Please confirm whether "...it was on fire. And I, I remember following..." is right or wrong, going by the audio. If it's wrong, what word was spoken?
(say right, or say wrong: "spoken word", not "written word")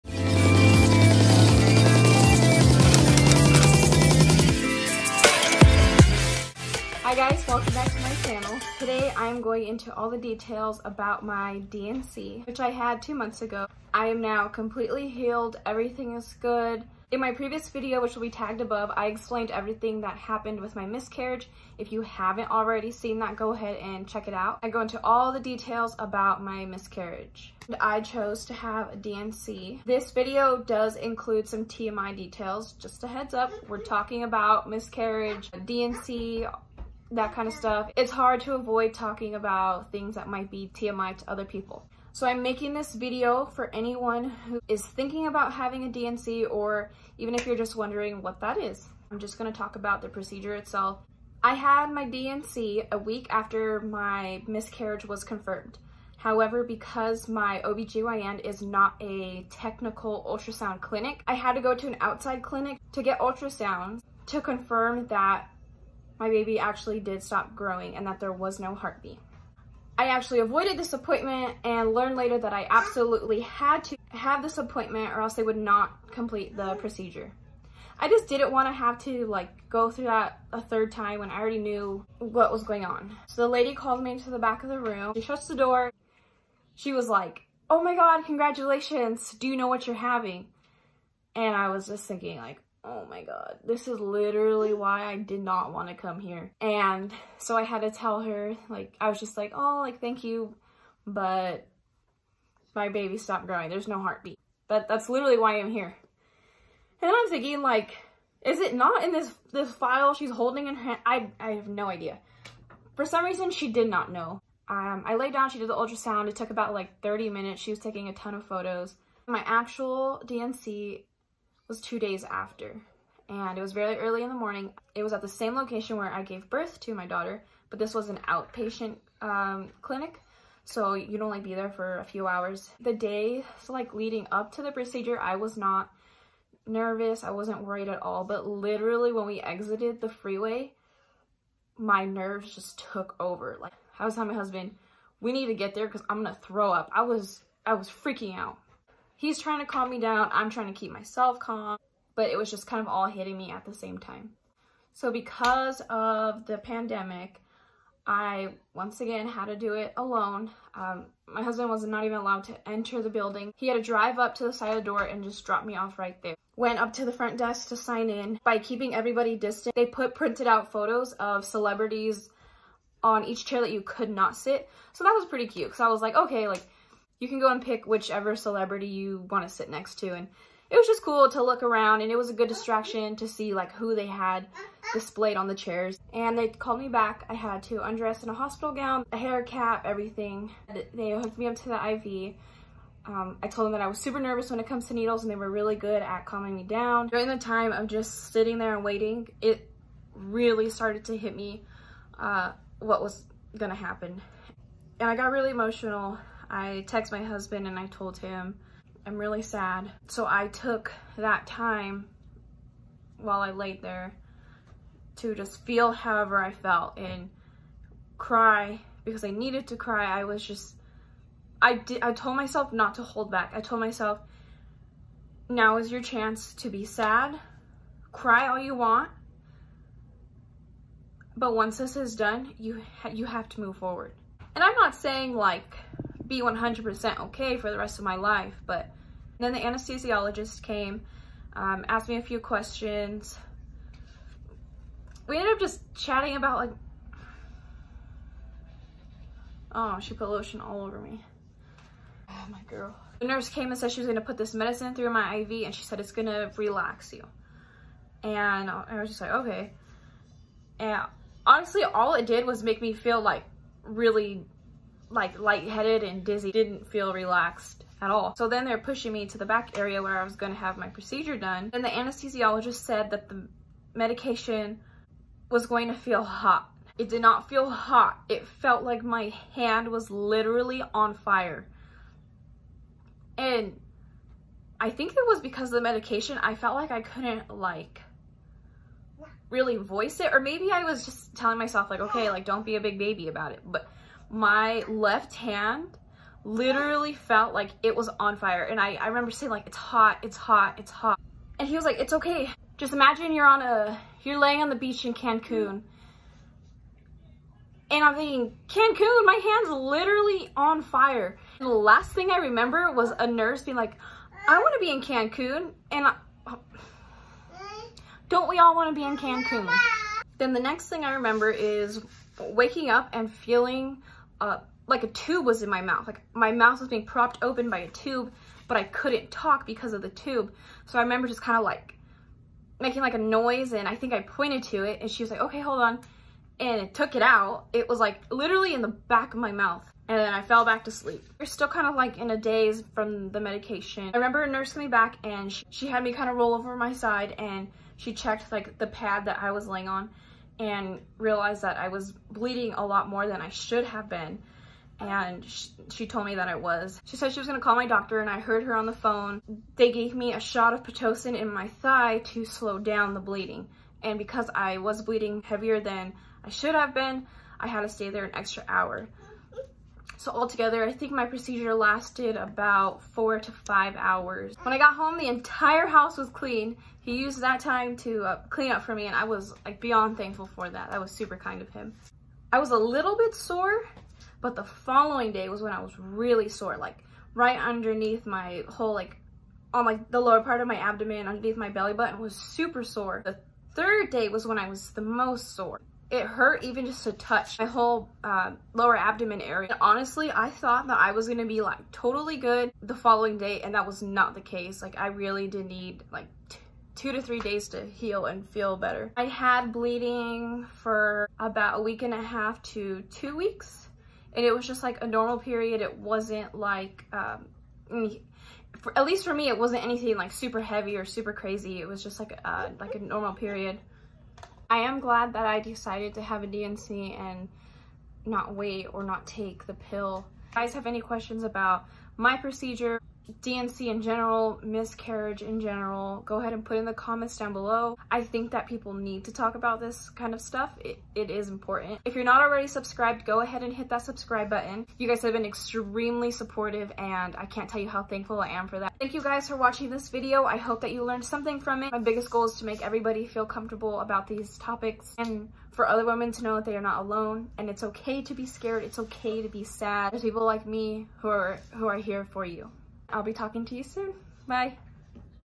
wrong: "saying", not "following".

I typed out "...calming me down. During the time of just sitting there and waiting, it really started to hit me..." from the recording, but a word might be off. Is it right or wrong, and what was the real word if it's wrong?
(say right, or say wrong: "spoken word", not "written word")
right.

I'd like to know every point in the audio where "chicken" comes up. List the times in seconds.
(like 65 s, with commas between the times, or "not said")
not said.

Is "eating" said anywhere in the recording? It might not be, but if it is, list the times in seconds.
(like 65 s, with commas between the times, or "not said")
not said.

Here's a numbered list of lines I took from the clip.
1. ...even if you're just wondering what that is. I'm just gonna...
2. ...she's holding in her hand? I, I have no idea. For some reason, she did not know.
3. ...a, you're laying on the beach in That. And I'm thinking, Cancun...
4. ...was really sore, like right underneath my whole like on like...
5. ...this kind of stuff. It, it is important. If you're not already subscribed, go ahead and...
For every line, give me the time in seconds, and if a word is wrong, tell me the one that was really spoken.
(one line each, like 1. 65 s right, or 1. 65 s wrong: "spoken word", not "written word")
1. 47 s right
2. 110 s right
3. 303 s wrong: "Cancun", not "That"
4. 385 s right
5. 439 s right.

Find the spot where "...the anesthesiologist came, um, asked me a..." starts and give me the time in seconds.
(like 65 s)
239 s.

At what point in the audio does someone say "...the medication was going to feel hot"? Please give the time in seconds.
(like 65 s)
273 s.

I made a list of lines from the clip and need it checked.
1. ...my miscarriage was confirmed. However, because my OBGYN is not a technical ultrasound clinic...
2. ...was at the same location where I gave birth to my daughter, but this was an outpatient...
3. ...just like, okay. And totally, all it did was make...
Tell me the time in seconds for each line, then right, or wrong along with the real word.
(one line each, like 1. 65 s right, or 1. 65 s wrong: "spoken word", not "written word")
1. 53 s right
2. 125 s right
3. 259 s wrong: "honestly", not "totally".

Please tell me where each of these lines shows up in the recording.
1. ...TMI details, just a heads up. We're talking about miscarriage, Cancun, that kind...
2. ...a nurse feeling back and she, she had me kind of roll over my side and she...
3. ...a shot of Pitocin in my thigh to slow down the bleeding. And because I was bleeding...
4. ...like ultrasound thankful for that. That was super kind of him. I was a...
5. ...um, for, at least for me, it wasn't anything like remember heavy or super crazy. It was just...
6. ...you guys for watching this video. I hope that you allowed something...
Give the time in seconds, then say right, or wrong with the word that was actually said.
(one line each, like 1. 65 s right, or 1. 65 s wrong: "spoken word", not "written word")
1. 31 s wrong: "DNC", not "Cancun"
2. 344 s wrong: "coming", not "feeling"
3. 360 s right
4. 379 s wrong: "beyond", not "ultrasound"
5. 417 s wrong: "super", not "remember"
6. 449 s wrong: "learned", not "allowed".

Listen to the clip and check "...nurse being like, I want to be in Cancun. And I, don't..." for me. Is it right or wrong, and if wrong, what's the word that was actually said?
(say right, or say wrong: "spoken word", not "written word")
right.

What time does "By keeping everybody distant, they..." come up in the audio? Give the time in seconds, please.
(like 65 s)
168 s.